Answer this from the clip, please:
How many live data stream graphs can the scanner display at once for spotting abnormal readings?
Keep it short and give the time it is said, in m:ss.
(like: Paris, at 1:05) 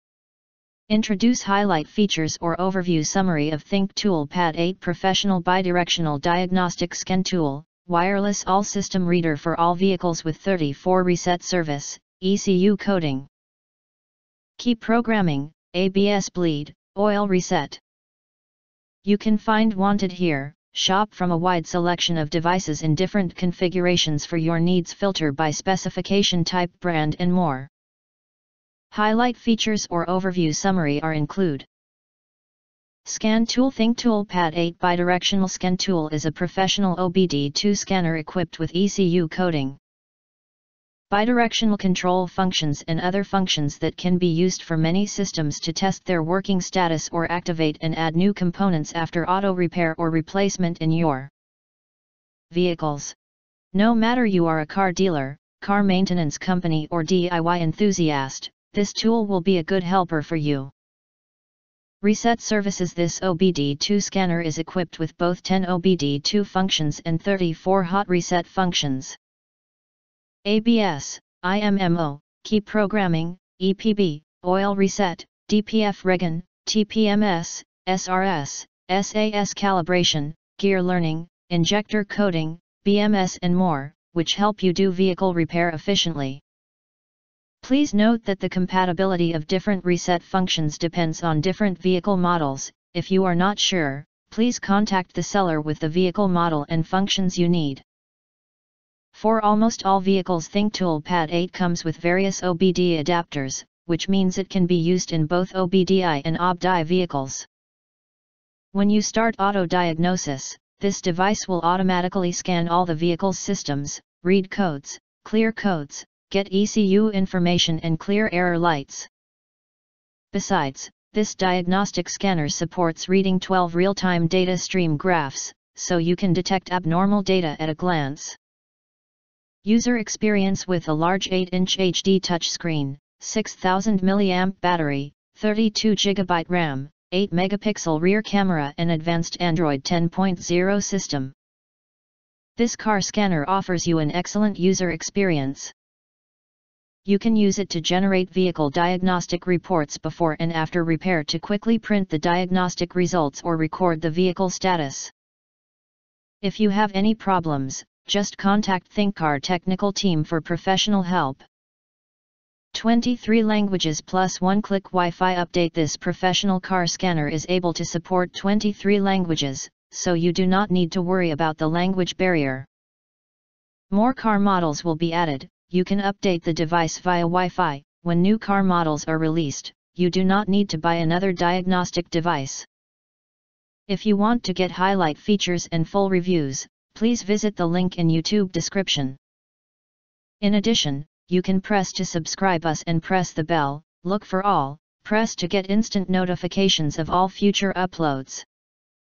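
12, at 2:03.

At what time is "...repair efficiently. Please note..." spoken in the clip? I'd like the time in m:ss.
1:25.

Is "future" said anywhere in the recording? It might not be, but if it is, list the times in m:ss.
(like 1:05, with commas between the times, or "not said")
3:17.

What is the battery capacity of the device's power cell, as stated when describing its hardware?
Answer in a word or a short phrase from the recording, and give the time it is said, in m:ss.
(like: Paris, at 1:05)
6000 mAh, at 2:13.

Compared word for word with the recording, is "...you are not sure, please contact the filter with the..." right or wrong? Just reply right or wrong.
wrong.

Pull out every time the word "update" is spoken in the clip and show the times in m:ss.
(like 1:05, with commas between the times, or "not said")
2:45, 2:56.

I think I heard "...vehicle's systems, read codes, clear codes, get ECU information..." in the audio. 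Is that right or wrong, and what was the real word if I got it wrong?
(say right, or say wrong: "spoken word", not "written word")
right.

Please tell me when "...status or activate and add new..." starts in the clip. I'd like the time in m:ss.
0:46.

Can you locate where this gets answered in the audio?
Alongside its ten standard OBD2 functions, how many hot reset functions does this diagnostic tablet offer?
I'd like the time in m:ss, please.
1:07.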